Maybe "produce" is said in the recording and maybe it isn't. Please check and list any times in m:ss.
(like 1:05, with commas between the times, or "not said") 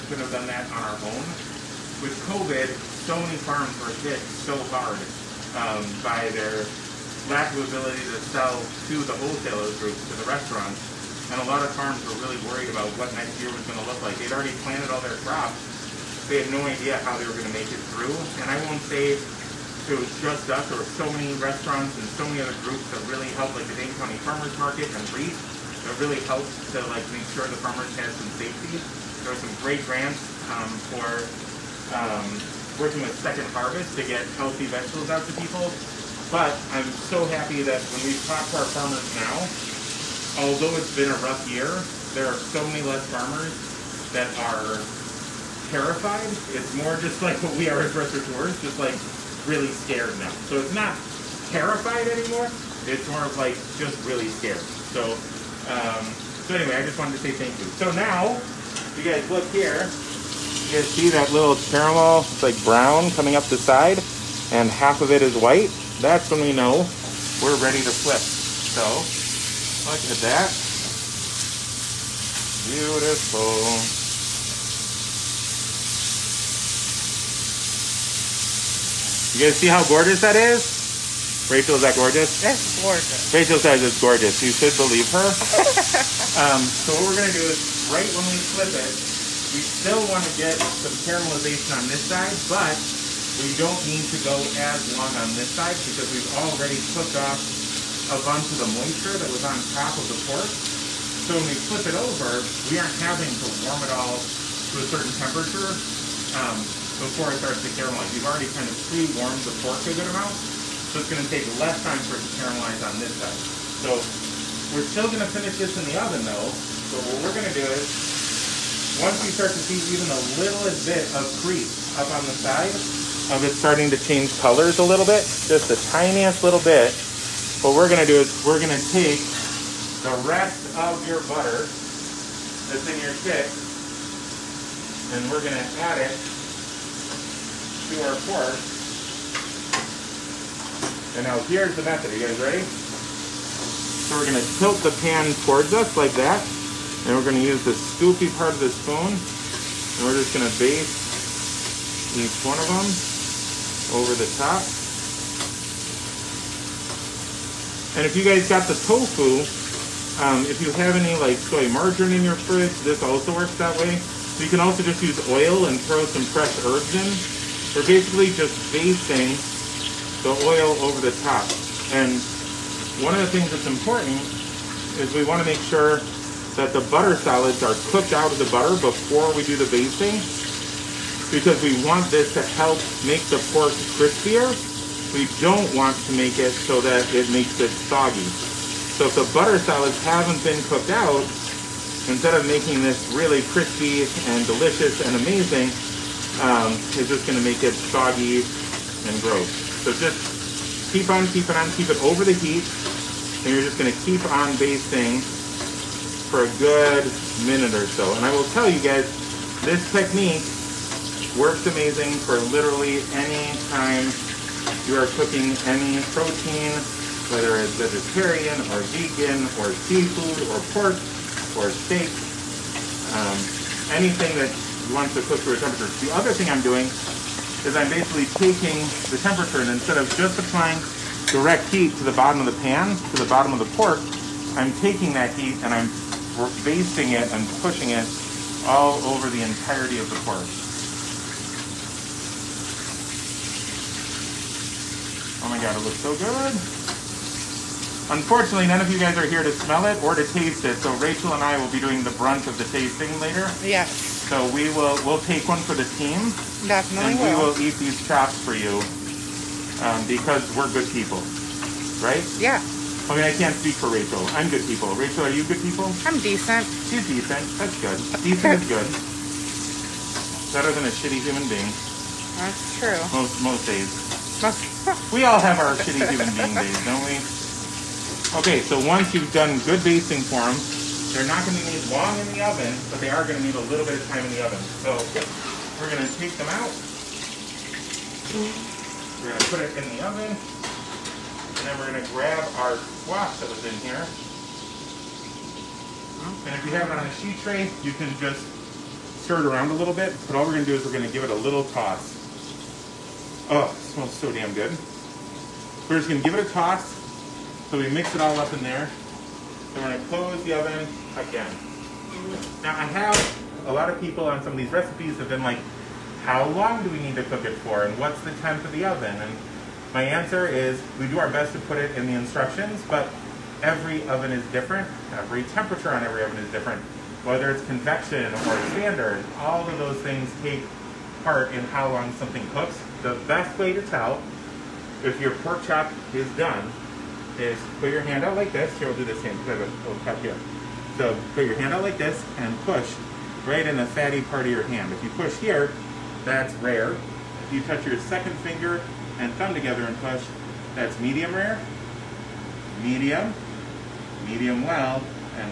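not said.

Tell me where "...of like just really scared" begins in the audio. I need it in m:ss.
0:53.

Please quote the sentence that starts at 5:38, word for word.
Here, we'll do this hand because I have a little cut here.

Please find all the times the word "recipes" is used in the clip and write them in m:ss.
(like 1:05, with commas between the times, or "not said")
5:14.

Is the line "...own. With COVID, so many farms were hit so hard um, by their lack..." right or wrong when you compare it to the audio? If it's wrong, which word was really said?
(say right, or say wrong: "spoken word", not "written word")
right.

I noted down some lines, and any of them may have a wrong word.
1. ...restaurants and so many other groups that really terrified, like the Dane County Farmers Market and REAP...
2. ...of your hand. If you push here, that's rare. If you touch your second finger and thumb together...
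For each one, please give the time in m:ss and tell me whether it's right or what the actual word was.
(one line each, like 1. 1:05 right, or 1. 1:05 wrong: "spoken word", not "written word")
1. 0:21 wrong: "helped", not "terrified"
2. 5:44 right.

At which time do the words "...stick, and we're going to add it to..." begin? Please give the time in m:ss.
2:13.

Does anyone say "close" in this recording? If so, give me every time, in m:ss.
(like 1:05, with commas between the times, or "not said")
5:10.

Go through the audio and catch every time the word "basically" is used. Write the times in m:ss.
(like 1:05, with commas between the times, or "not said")
2:47, 3:47.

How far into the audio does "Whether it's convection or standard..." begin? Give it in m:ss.
5:27.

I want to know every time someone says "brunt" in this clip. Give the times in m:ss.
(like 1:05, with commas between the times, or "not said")
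4:12.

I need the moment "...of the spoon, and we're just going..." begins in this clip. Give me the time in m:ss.
2:28.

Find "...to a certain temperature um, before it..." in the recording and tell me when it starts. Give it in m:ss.
1:44.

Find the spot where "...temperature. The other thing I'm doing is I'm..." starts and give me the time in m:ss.
3:45.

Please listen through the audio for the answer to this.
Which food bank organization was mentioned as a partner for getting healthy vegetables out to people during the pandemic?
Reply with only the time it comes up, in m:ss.
0:33.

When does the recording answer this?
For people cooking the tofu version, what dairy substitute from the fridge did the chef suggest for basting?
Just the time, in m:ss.
2:41.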